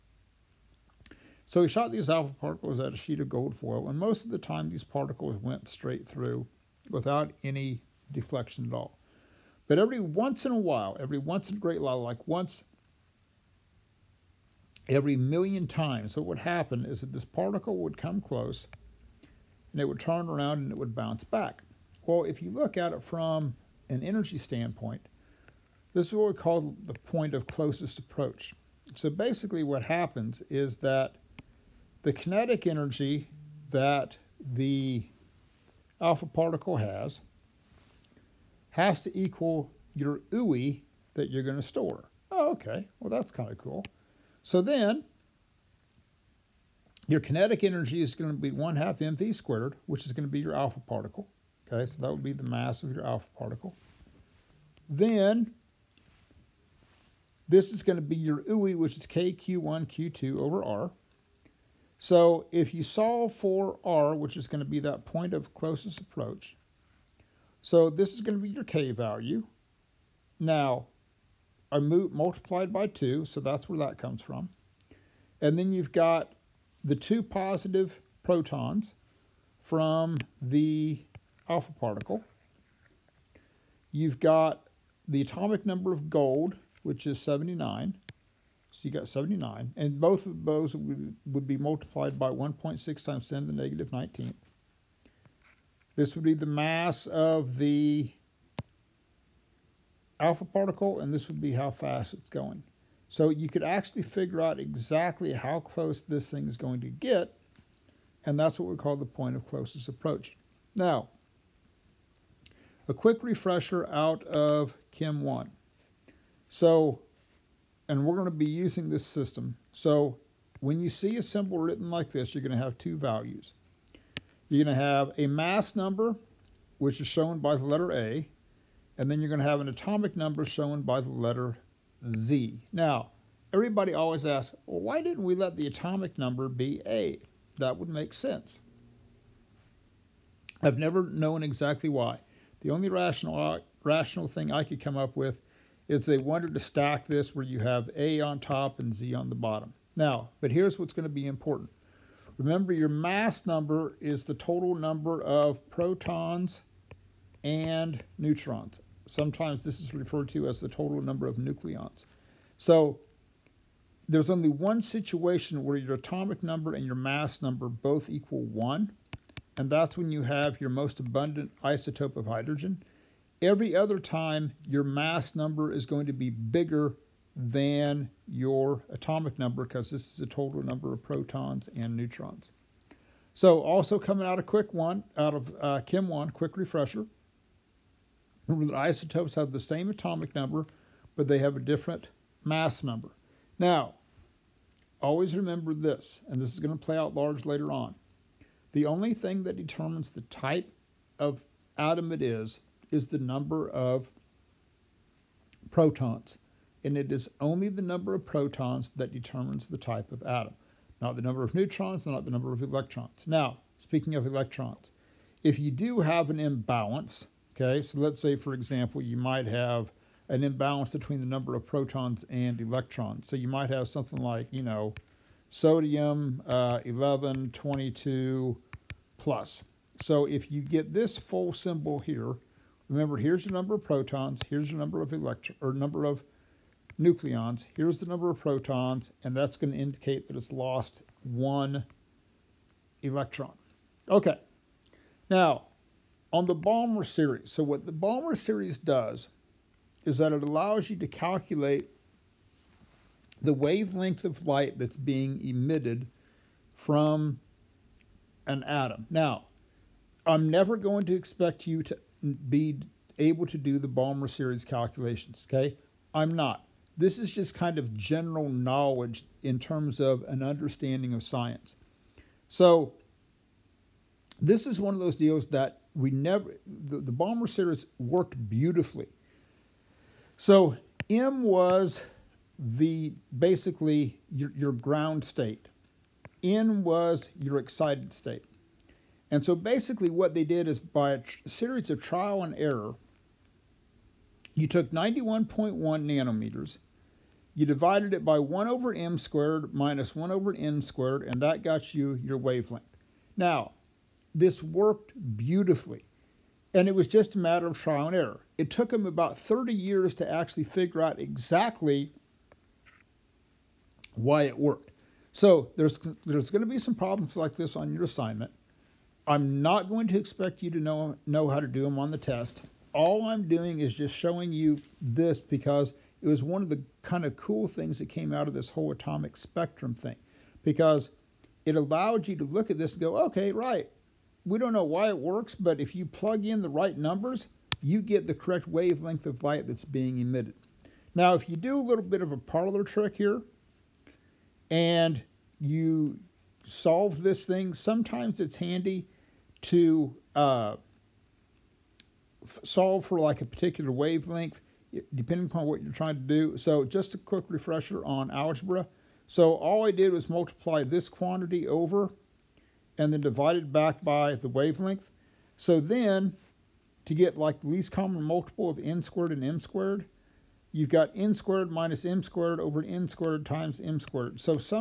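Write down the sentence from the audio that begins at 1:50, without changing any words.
Now, a quick refresher out of Chem 1.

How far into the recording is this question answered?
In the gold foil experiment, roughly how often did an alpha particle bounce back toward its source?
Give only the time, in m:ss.
0:12.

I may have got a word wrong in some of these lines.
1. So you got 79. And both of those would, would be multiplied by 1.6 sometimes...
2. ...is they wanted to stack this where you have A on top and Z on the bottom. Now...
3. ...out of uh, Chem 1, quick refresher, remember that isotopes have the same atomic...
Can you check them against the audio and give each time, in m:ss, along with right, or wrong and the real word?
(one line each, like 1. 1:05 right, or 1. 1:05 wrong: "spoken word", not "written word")
1. 1:28 wrong: "times", not "sometimes"
2. 2:25 right
3. 3:05 right.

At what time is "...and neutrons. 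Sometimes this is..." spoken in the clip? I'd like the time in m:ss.
2:37.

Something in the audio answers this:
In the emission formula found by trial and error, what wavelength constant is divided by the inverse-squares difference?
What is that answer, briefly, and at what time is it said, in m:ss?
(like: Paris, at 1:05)
91.1 nanometers, at 4:54.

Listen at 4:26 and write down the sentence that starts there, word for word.
This is just kind of general knowledge in terms of an understanding of science.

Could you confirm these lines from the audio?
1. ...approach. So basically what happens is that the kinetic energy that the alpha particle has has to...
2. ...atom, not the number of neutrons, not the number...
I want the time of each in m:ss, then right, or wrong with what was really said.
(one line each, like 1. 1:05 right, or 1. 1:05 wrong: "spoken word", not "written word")
1. 0:27 right
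2. 3:30 right.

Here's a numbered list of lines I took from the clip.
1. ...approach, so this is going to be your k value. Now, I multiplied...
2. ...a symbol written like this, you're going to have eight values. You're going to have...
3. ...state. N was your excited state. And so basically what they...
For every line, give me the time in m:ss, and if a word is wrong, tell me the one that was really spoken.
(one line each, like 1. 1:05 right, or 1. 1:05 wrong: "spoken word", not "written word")
1. 1:05 right
2. 2:01 wrong: "two", not "eight"
3. 4:45 right.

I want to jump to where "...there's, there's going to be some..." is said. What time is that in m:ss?
5:15.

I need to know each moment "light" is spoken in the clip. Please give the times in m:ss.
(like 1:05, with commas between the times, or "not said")
4:14, 5:39.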